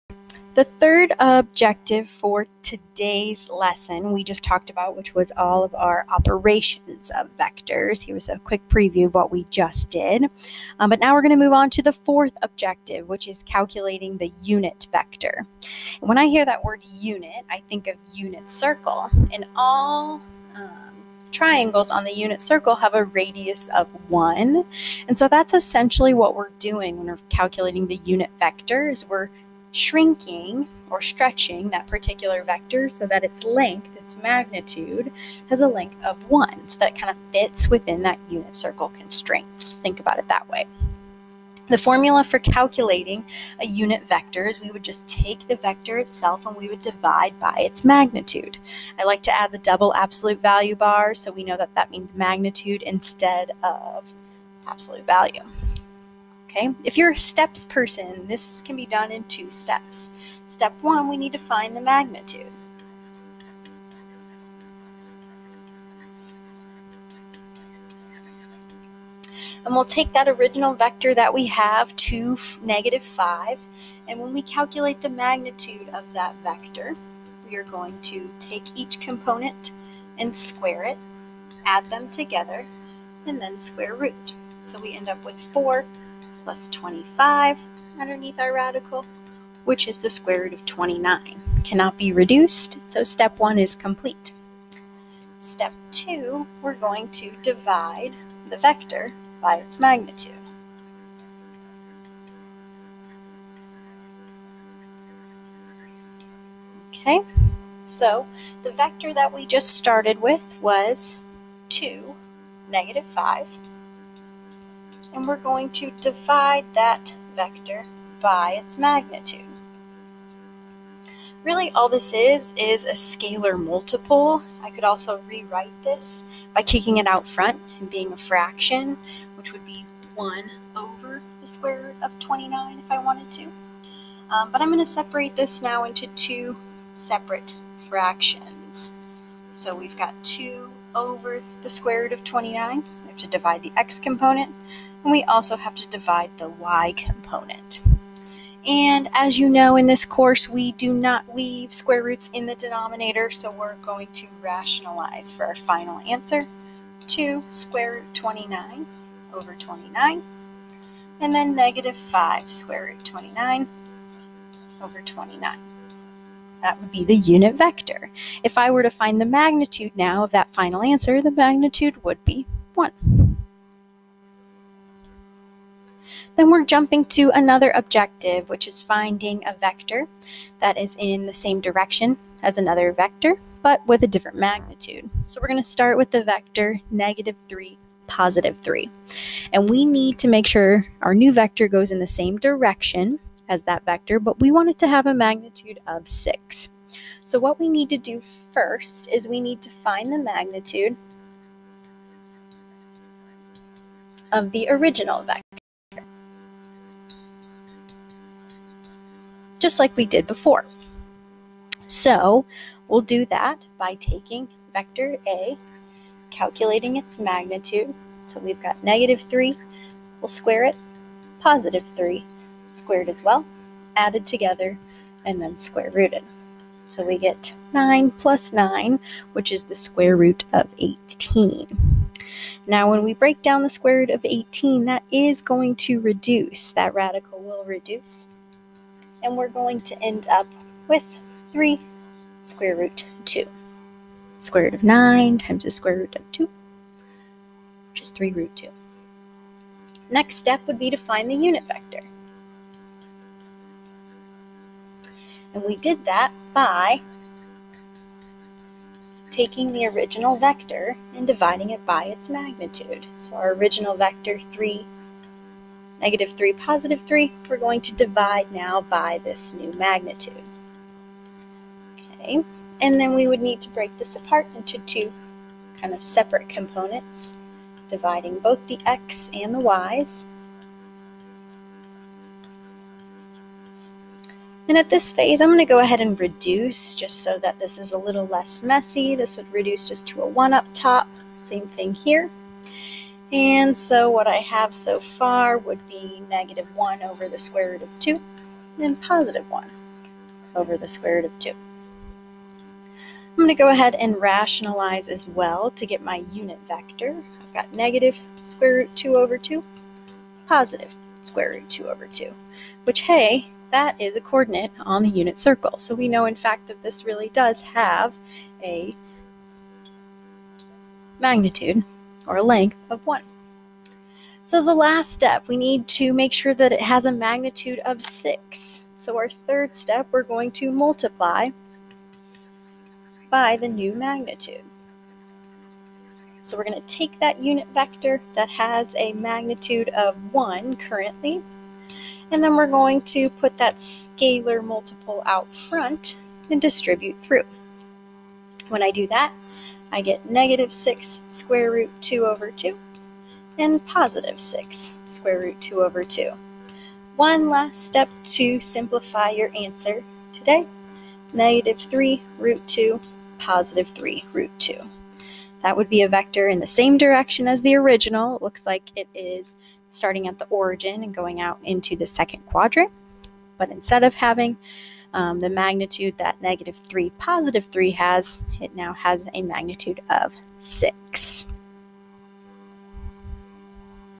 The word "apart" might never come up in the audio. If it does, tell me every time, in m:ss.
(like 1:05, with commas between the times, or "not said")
4:34.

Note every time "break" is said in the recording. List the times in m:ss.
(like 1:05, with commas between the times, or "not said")
3:53, 4:33.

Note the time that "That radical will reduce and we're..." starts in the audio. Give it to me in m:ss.
3:56.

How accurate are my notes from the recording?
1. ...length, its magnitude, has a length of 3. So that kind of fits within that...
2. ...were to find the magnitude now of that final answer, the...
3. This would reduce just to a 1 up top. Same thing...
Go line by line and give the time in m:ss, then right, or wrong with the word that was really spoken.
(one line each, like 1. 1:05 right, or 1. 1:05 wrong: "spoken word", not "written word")
1. 0:33 wrong: "1", not "3"
2. 2:48 right
3. 4:49 right.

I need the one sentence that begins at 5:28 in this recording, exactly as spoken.
So our third step, we're going to multiply by the new magnitude.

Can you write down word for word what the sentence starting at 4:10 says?
Next step would be to find the unit vector.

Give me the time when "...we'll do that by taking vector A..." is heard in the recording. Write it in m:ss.
3:32.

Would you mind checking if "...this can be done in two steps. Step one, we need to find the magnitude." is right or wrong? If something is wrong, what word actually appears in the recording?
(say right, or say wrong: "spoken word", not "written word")
right.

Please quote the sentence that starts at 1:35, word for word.
Step two, we're going to divide the vector by its magnitude.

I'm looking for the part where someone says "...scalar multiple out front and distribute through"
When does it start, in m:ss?
5:43.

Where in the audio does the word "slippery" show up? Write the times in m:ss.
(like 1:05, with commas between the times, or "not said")
not said.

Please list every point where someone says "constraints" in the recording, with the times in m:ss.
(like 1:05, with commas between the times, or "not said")
0:38.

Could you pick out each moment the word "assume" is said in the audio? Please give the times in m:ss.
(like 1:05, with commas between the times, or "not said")
not said.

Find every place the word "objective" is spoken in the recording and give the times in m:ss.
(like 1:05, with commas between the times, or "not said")
0:01, 0:12, 2:57.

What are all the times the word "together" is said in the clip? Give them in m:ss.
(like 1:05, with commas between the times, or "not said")
1:22, 3:44.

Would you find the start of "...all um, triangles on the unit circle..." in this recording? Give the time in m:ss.
0:19.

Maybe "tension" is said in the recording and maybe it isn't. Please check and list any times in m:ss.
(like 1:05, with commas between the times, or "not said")
not said.